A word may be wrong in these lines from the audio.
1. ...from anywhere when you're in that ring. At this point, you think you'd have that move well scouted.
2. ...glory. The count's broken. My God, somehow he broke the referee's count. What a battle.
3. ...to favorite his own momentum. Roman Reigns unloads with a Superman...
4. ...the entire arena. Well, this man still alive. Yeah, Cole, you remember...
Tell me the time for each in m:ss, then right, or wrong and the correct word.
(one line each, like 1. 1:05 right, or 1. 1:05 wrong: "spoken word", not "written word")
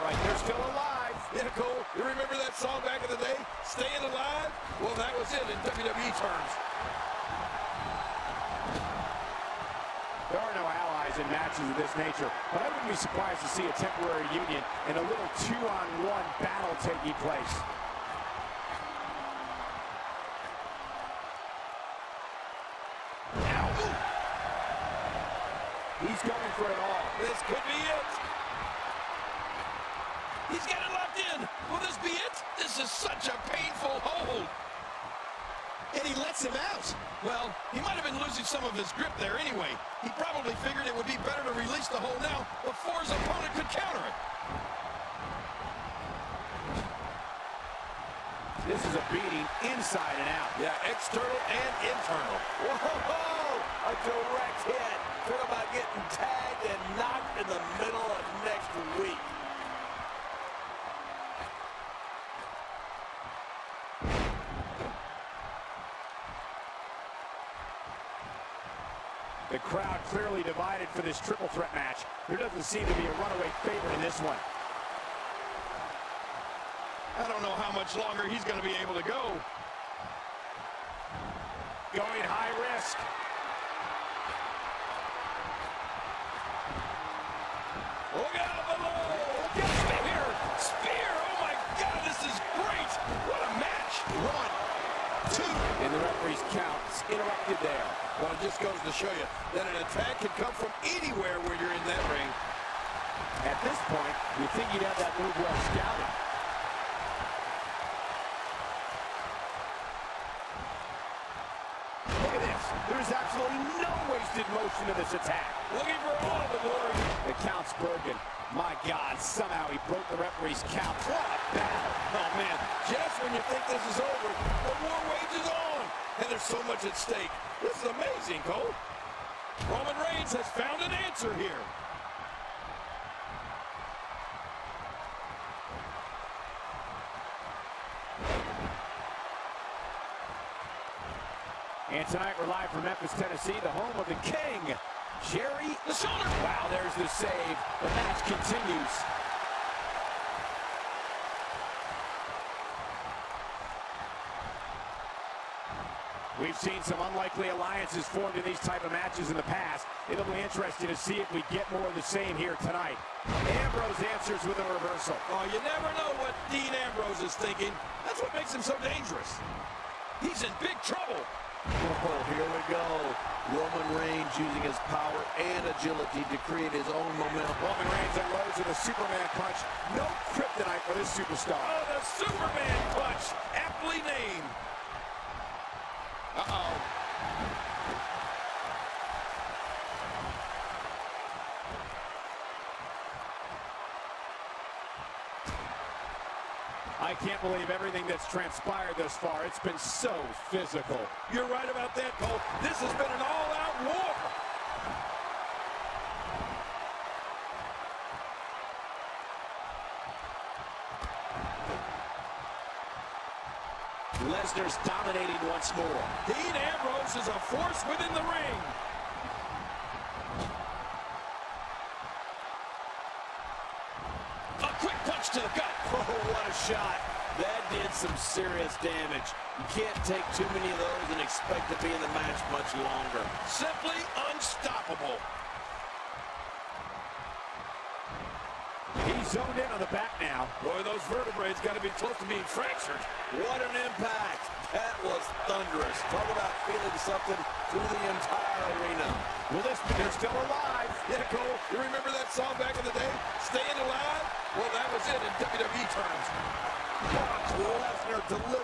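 1. 1:40 right
2. 1:56 right
3. 2:56 wrong: "create", not "favorite"
4. 4:07 right.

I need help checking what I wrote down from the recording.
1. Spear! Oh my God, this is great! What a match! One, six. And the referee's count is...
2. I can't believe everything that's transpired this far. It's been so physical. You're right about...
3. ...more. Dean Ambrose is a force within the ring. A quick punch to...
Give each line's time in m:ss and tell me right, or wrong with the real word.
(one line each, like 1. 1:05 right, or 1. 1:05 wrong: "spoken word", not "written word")
1. 1:30 wrong: "two", not "six"
2. 3:17 right
3. 3:35 right.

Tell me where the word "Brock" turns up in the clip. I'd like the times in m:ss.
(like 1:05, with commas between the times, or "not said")
4:17.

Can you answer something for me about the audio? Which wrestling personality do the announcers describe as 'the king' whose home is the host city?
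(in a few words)
Jerry Lawler.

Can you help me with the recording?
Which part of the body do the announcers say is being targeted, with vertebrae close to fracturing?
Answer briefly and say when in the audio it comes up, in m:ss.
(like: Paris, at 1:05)
The back, at 3:59.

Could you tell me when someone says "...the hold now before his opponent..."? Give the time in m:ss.
0:41.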